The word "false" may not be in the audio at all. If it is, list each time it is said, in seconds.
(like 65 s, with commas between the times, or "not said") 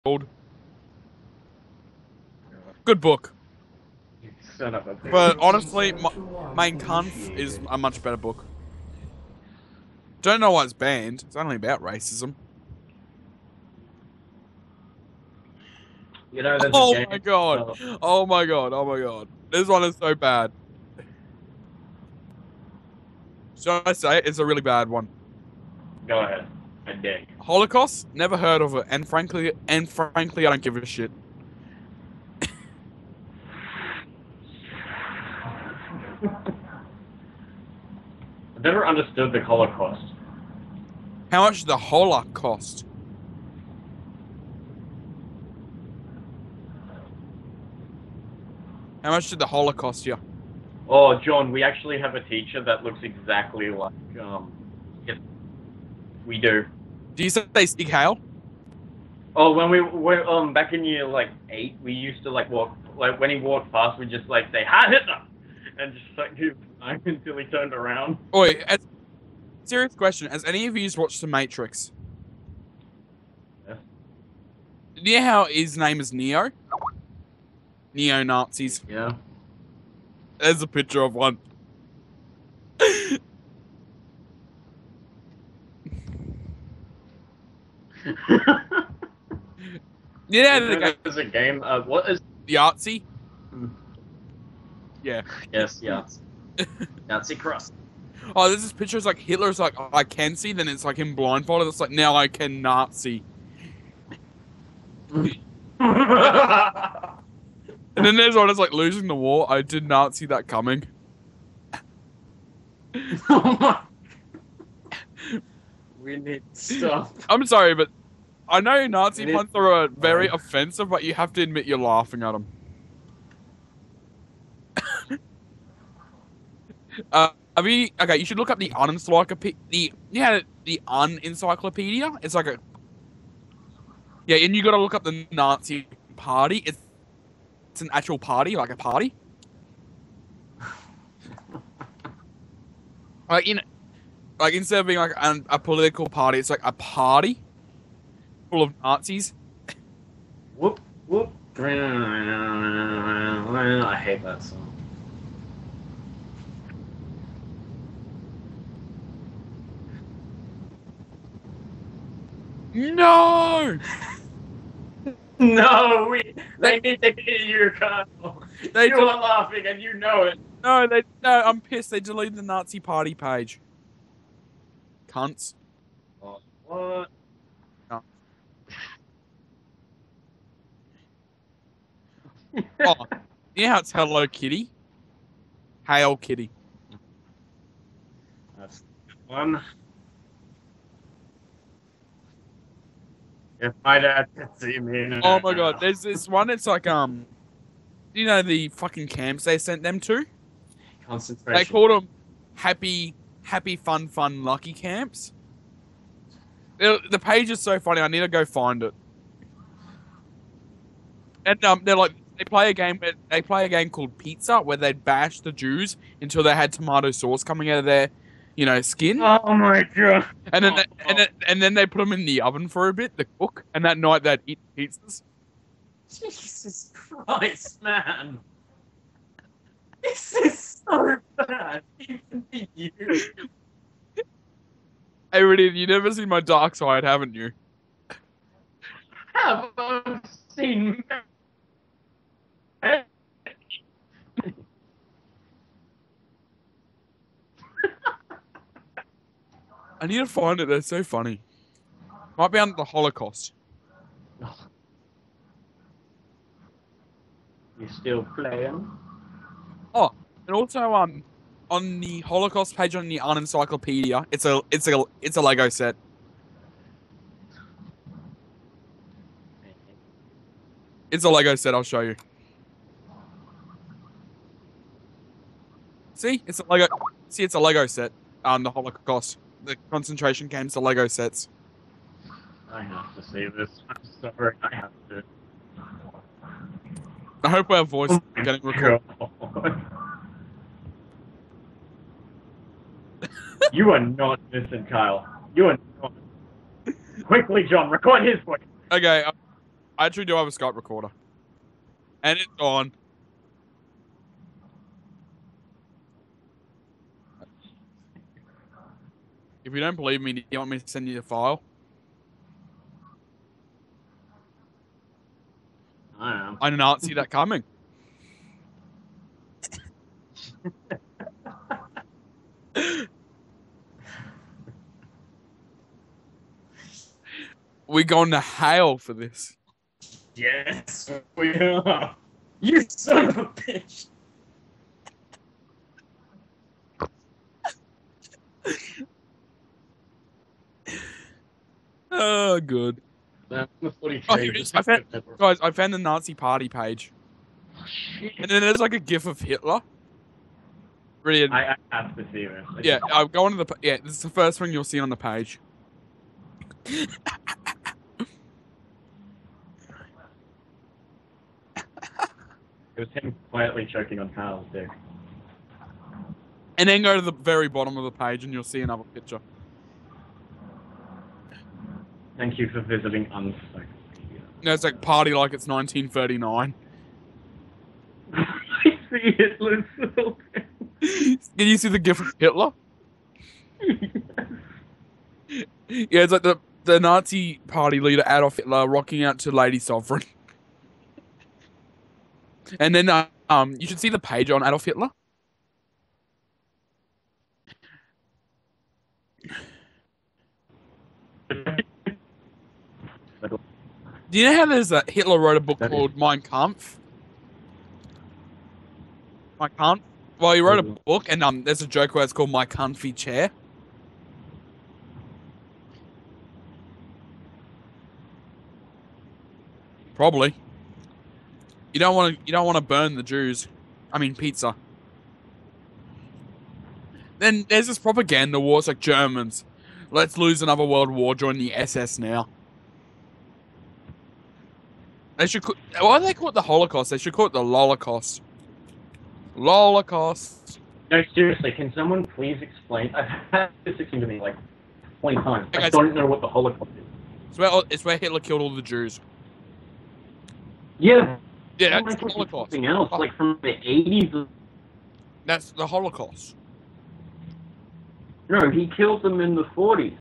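not said.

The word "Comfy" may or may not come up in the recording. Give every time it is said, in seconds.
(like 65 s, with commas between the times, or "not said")
412 s.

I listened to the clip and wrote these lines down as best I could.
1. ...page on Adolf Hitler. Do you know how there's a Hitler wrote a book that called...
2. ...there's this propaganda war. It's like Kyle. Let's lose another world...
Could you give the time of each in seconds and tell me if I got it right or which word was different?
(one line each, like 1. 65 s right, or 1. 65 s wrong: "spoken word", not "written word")
1. 394 s right
2. 427 s wrong: "Germans", not "Kyle".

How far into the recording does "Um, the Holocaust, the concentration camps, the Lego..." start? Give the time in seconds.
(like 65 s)
278 s.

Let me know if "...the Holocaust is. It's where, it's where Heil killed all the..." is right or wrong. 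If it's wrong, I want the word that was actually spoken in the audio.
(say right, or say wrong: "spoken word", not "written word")
wrong: "Hitler", not "Heil".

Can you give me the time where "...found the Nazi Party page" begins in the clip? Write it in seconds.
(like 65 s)
345 s.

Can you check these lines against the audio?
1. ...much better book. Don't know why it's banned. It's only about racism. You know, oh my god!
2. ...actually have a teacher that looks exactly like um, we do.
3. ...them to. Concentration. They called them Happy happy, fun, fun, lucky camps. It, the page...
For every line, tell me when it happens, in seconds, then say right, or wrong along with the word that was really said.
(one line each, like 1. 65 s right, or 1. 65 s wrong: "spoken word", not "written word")
1. 7 s right
2. 51 s right
3. 199 s right.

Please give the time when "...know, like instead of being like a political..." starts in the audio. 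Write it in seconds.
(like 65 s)
143 s.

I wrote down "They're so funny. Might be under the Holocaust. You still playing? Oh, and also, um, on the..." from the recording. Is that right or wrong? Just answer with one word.
right.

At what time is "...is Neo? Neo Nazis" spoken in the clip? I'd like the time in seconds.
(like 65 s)
75 s.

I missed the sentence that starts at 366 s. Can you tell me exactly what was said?
And then go to the very bottom of the page and you'll see another picture.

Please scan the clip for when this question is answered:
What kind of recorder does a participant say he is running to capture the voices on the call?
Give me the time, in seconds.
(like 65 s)
300 s.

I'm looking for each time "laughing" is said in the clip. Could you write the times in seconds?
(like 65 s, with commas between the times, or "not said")
121 s, 169 s.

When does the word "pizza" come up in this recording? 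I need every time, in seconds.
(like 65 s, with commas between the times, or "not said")
214 s, 224 s, 424 s.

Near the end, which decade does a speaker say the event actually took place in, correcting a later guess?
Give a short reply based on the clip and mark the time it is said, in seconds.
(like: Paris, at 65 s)
the forties, at 459 s.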